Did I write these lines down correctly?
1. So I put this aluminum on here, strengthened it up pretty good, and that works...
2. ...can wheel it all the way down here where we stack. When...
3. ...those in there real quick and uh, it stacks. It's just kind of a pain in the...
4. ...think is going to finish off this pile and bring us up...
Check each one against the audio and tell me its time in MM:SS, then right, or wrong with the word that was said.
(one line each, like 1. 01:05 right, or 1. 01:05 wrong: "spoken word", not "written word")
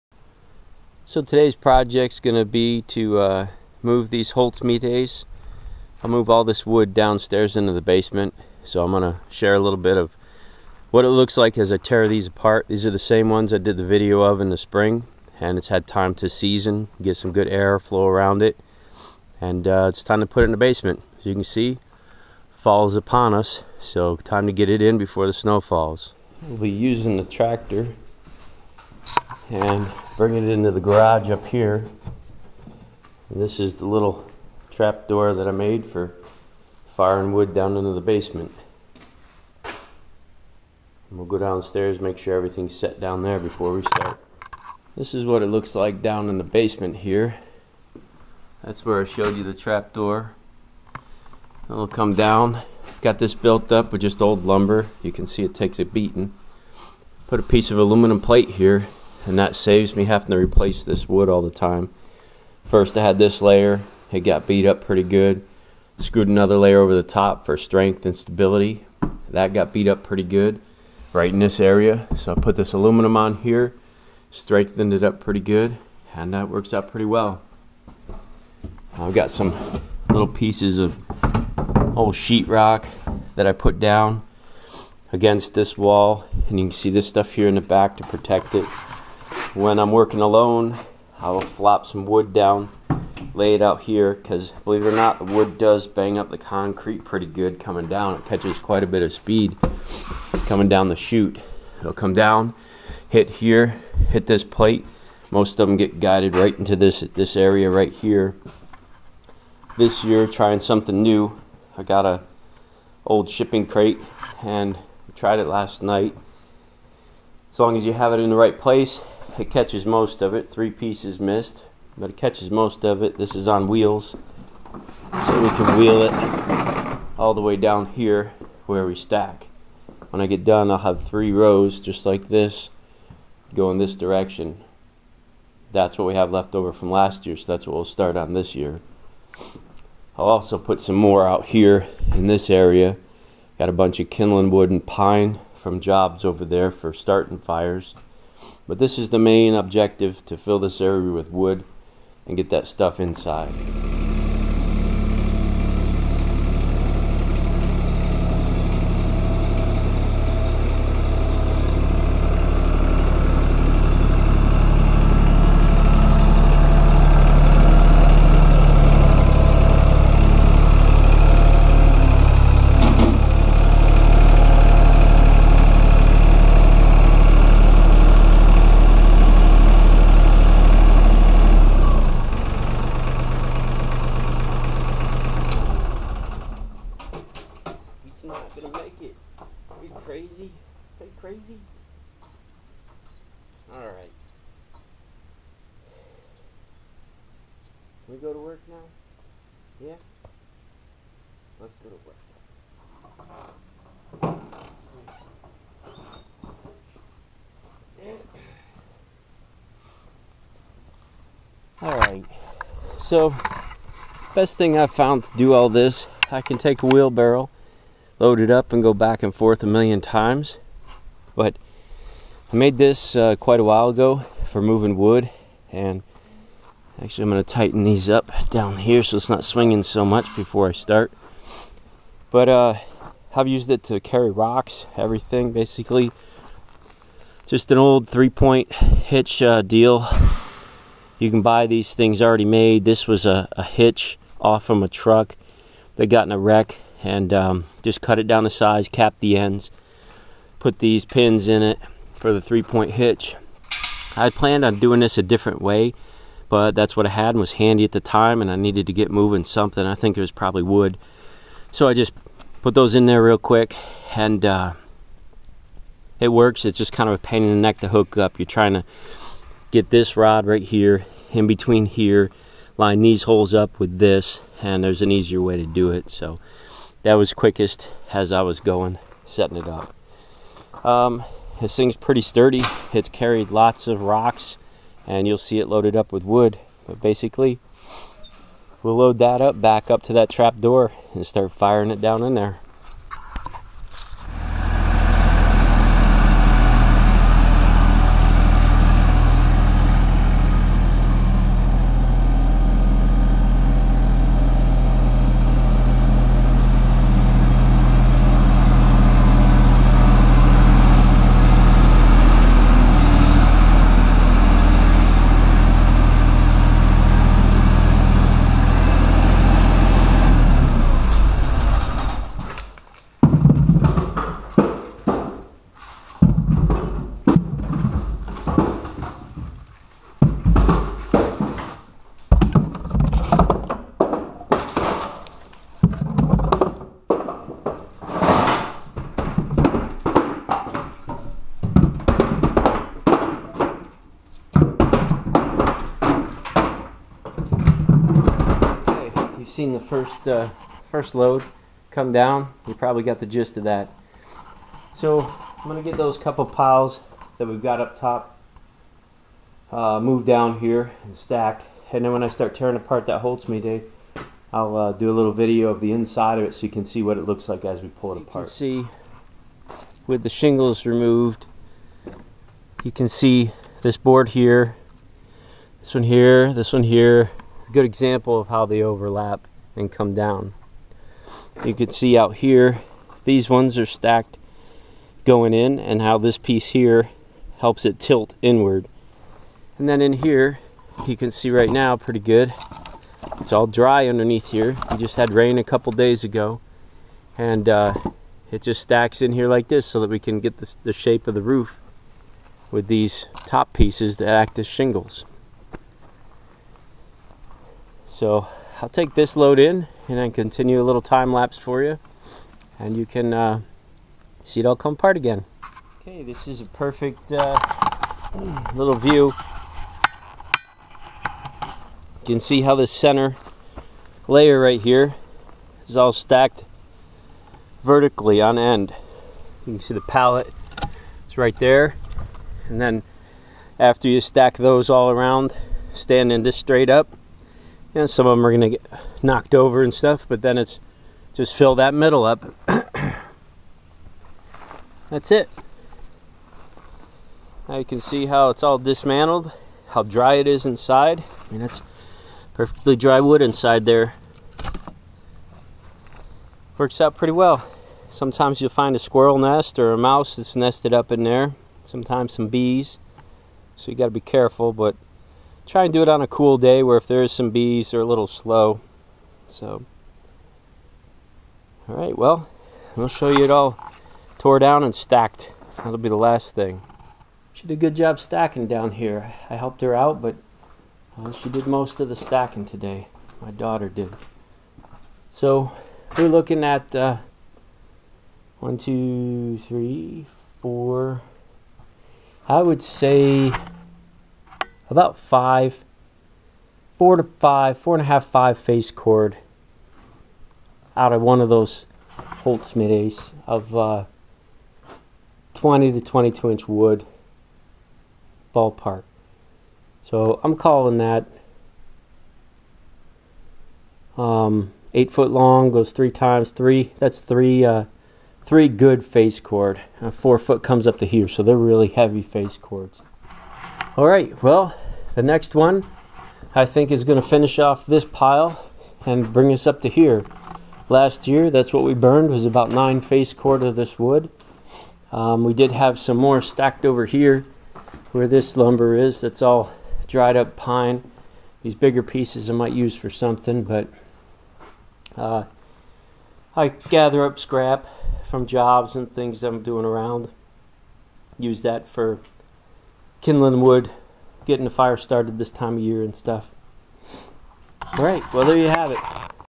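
1. 01:12 right
2. 02:05 right
3. 04:22 wrong: "works", not "stacks"
4. 08:46 right.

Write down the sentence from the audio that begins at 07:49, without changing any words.
So, all right, well, I'll show you it all tore down and stacked.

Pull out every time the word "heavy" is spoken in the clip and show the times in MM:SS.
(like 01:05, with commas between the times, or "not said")
08:41.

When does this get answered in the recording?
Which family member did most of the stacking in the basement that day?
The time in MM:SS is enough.
08:03.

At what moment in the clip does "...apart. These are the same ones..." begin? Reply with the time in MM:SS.
00:12.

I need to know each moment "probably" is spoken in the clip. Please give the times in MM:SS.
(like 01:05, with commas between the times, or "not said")
04:20, 05:52.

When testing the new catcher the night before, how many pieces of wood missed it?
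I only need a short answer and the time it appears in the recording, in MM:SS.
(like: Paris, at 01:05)
3, at 02:00.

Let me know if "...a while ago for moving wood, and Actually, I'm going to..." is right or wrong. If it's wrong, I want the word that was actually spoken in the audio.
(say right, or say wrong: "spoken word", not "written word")
right.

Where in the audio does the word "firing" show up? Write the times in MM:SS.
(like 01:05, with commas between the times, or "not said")
00:36, 04:51.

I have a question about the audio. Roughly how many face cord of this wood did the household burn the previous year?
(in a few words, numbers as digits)
9.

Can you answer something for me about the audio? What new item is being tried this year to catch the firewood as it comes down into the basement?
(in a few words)
shipping crate.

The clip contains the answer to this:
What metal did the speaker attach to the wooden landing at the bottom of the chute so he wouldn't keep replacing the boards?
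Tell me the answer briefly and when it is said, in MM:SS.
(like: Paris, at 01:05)
aluminum plate, at 00:57.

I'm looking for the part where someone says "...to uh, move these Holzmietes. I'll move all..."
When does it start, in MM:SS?
00:02.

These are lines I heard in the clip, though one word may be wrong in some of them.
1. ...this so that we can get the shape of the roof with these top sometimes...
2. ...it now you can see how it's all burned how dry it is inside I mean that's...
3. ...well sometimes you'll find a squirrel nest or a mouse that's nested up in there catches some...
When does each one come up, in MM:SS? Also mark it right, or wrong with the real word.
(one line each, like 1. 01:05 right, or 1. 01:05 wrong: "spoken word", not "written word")
1. 06:39 wrong: "pieces", not "sometimes"
2. 07:25 wrong: "dismantled", not "burned"
3. 07:37 wrong: "sometimes", not "catches".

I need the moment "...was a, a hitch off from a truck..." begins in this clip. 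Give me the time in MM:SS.
04:03.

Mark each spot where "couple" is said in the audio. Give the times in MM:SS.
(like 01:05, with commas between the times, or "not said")
05:56, 06:35.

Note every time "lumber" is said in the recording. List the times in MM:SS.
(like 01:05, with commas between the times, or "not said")
00:54, 08:58.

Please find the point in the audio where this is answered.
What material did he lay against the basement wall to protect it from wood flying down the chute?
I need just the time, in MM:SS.
01:22.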